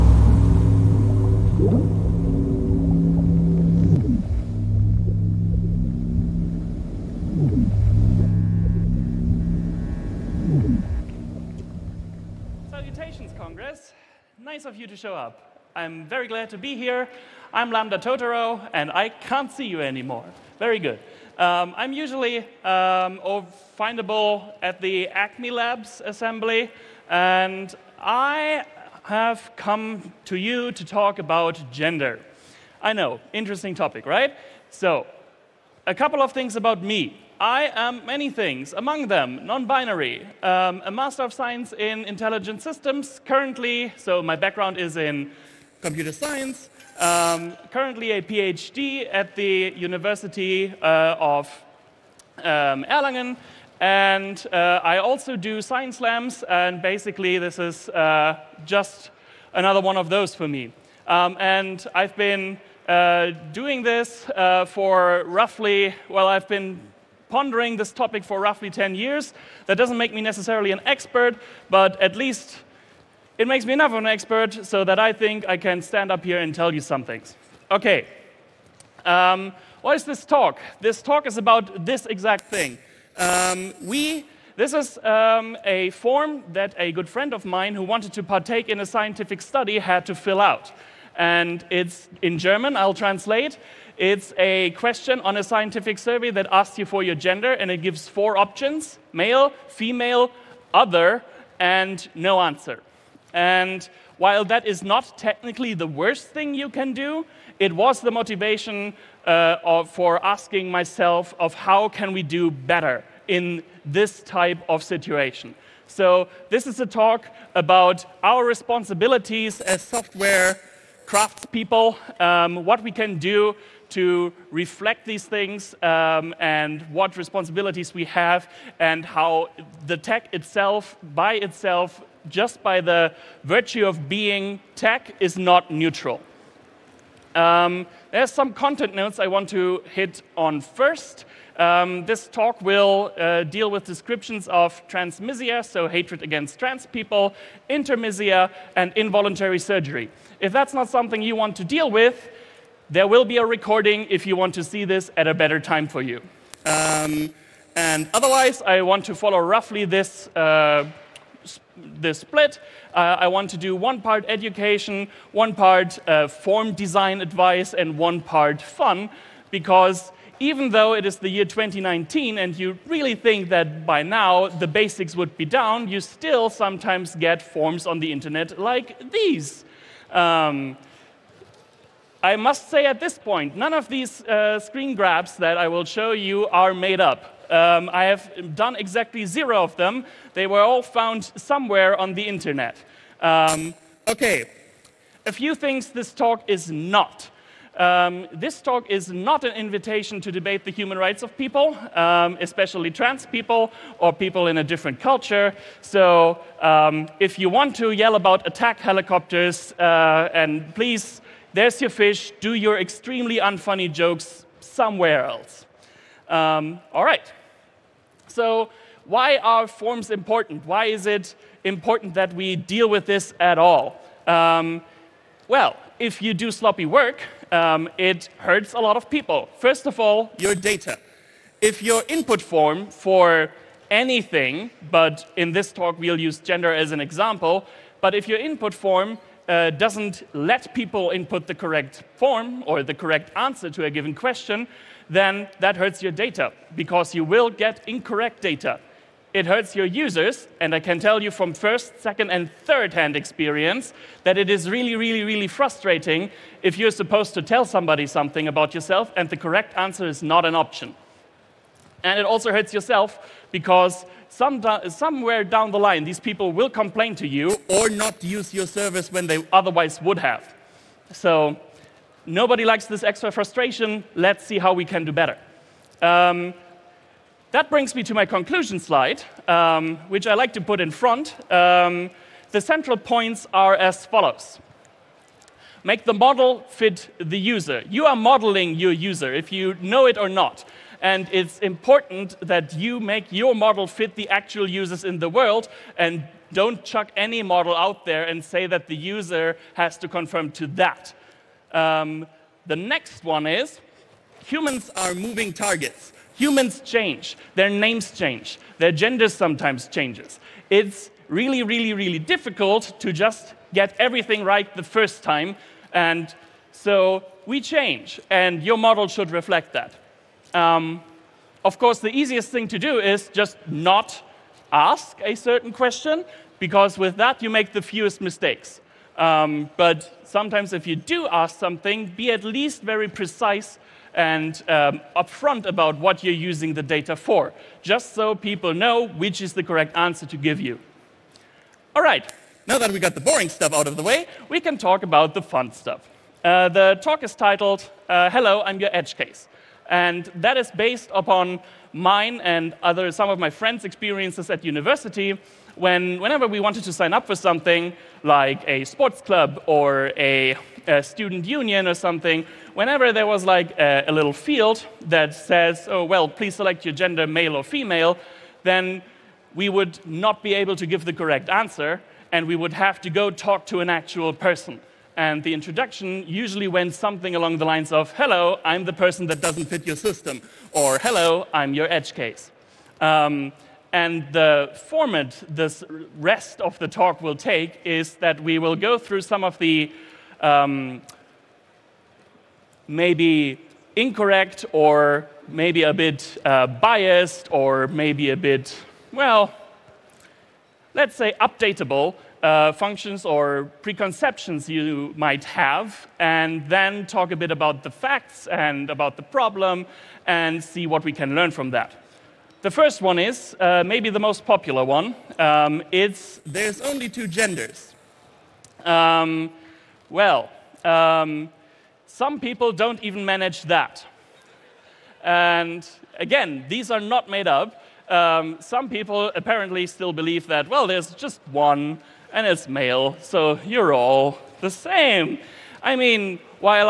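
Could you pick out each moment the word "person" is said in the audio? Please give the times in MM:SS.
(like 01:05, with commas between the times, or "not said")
06:14, 06:18.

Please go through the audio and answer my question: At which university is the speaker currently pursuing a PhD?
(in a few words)
Erlangen.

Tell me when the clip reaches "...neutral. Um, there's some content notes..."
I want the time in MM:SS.
02:15.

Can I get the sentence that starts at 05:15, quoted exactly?
And so we change, and your model should reflect that.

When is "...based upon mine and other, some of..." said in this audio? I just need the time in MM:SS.
05:50.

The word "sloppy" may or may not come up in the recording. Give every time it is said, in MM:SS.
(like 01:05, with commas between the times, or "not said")
03:46.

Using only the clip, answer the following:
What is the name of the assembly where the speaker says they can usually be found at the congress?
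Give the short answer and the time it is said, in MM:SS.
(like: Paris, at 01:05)
Acme Labs, at 00:25.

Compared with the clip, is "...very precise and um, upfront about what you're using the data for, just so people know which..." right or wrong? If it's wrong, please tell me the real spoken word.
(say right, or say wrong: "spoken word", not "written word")
right.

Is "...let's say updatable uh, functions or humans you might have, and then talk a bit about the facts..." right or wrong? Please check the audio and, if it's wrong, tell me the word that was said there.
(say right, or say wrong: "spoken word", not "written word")
wrong: "preconceptions", not "humans".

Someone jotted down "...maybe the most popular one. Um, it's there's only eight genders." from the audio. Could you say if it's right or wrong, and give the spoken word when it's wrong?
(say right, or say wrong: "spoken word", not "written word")
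wrong: "two", not "eight".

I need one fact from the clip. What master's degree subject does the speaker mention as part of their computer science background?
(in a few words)
Intelligent Systems.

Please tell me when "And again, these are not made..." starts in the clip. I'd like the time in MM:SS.
07:05.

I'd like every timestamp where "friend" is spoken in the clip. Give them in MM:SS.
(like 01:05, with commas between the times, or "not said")
01:27, 05:53.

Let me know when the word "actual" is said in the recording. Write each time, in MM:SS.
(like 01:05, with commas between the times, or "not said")
04:54, 06:13.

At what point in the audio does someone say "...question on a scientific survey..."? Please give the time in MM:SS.
01:34.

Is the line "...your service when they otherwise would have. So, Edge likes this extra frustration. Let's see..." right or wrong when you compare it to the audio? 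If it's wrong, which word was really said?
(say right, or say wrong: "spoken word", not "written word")
wrong: "Nobody", not "Edge".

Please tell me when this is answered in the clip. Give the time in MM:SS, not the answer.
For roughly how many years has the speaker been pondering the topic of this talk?
01:08.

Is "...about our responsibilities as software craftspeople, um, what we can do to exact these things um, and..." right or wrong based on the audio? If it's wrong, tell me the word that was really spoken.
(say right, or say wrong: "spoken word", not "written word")
wrong: "reflect", not "exact".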